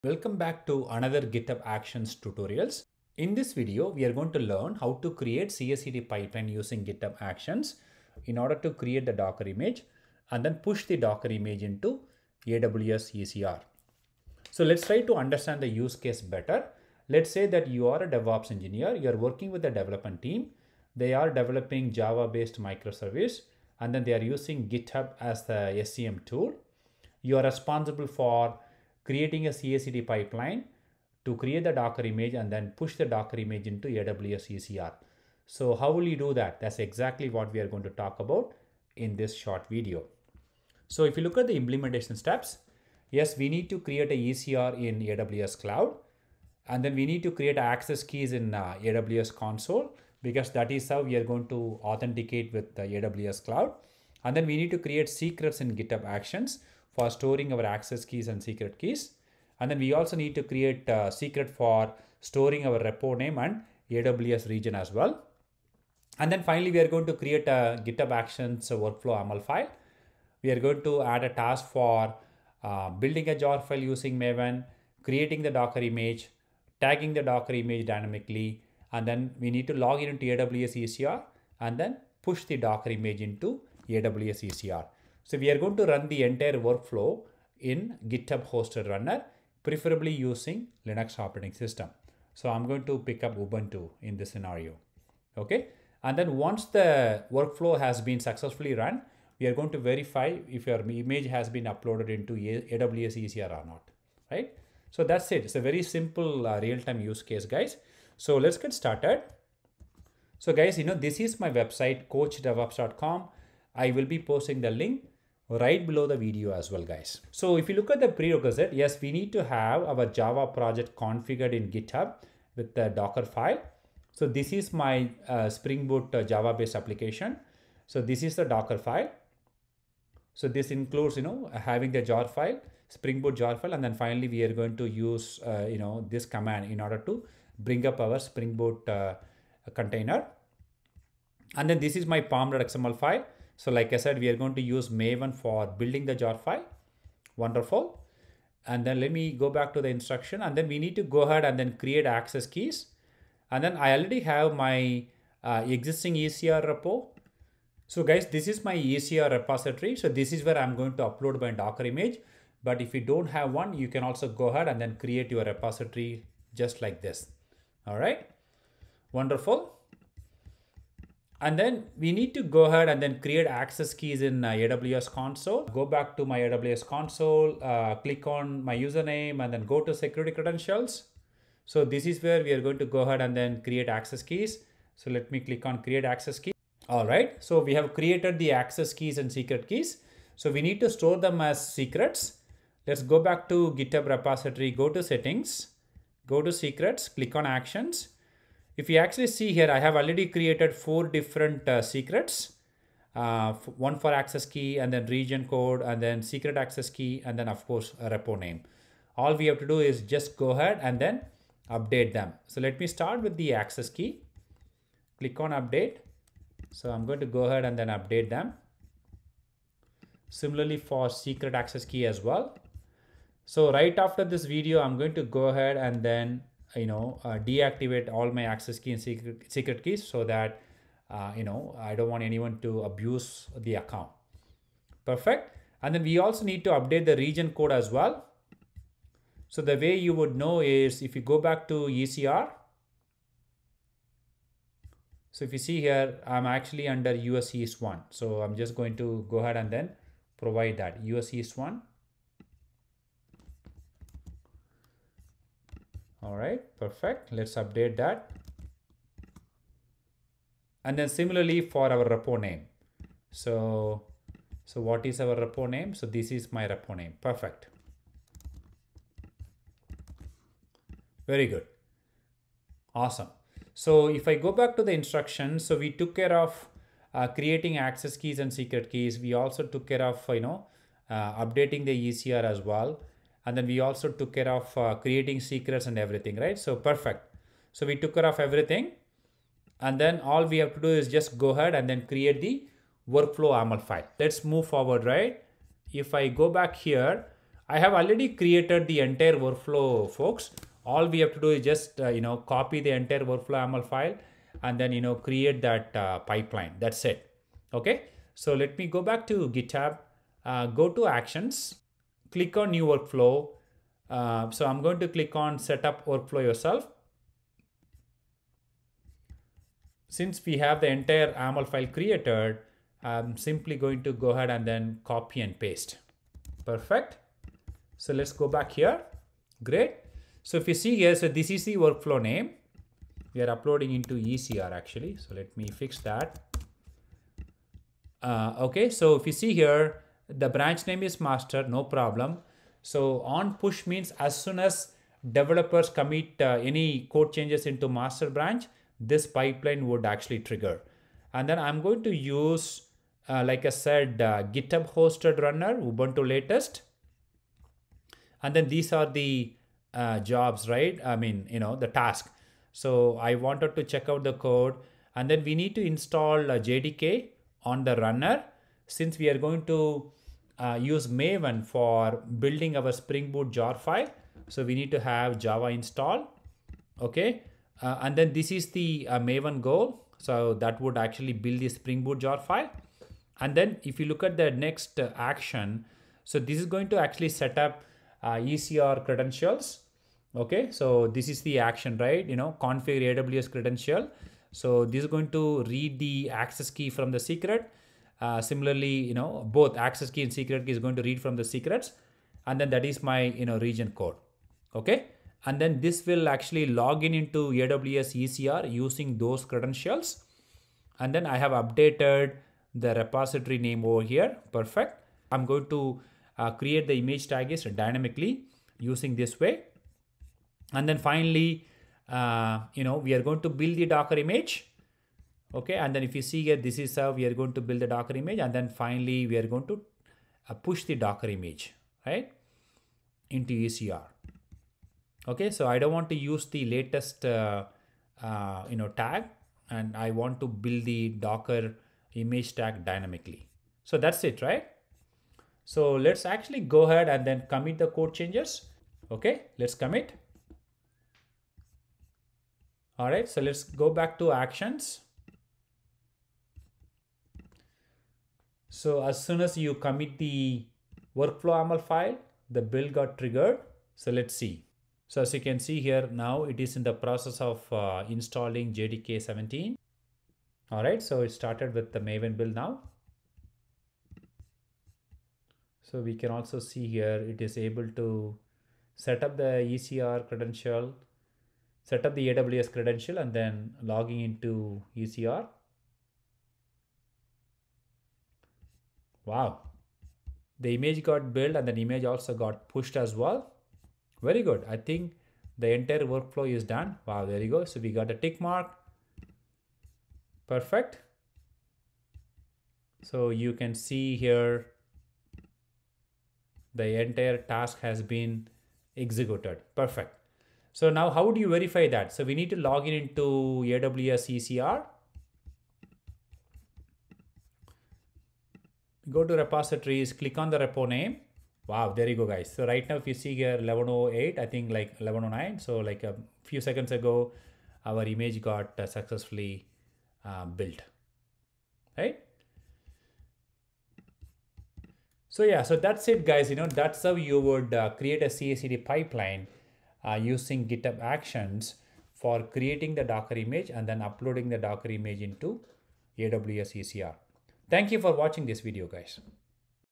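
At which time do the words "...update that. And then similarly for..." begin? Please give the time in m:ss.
4:17.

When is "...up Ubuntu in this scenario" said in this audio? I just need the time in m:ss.
1:33.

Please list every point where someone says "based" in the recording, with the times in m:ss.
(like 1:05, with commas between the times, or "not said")
0:21, 2:06.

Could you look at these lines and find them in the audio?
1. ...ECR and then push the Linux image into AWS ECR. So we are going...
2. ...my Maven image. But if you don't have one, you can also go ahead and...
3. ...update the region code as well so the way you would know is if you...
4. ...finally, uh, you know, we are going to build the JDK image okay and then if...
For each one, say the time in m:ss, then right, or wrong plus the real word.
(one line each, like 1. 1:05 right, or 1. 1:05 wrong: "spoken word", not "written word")
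1. 1:20 wrong: "Docker", not "Linux"
2. 2:41 wrong: "Docker", not "Maven"
3. 3:56 right
4. 7:00 wrong: "Docker", not "JDK".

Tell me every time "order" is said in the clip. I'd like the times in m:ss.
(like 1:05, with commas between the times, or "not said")
0:08, 2:16.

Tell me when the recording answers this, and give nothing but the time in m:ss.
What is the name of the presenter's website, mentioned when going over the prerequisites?
1:52.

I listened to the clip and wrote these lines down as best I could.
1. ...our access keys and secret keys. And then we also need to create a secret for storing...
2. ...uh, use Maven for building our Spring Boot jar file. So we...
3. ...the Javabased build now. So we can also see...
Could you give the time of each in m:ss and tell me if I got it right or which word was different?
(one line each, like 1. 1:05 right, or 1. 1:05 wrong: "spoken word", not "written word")
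1. 0:57 right
2. 6:10 right
3. 7:51 wrong: "Maven", not "Javabased".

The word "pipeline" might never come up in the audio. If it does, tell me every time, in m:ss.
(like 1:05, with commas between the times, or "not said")
0:06, 0:30, 5:06, 5:49, 8:58.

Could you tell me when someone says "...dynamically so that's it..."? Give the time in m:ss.
7:22.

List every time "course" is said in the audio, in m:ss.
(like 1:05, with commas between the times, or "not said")
3:27.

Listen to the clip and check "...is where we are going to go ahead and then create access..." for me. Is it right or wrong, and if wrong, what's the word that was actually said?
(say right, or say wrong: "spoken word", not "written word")
right.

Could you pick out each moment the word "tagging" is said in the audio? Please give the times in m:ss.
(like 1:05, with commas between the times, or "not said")
1:16.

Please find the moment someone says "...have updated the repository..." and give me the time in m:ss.
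6:51.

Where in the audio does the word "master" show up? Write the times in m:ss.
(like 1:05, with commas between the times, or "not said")
5:41, 5:47.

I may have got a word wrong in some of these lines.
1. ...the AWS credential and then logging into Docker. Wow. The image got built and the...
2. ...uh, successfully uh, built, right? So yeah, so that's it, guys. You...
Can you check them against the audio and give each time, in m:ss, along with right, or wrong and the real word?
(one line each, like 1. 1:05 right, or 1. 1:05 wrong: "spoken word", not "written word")
1. 8:02 wrong: "ECR", not "Docker"
2. 8:48 right.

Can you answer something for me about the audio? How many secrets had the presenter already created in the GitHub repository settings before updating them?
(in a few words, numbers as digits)
4.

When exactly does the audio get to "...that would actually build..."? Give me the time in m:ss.
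6:20.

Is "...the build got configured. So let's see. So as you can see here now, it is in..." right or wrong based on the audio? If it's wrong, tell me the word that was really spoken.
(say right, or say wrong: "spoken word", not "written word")
wrong: "triggered", not "configured".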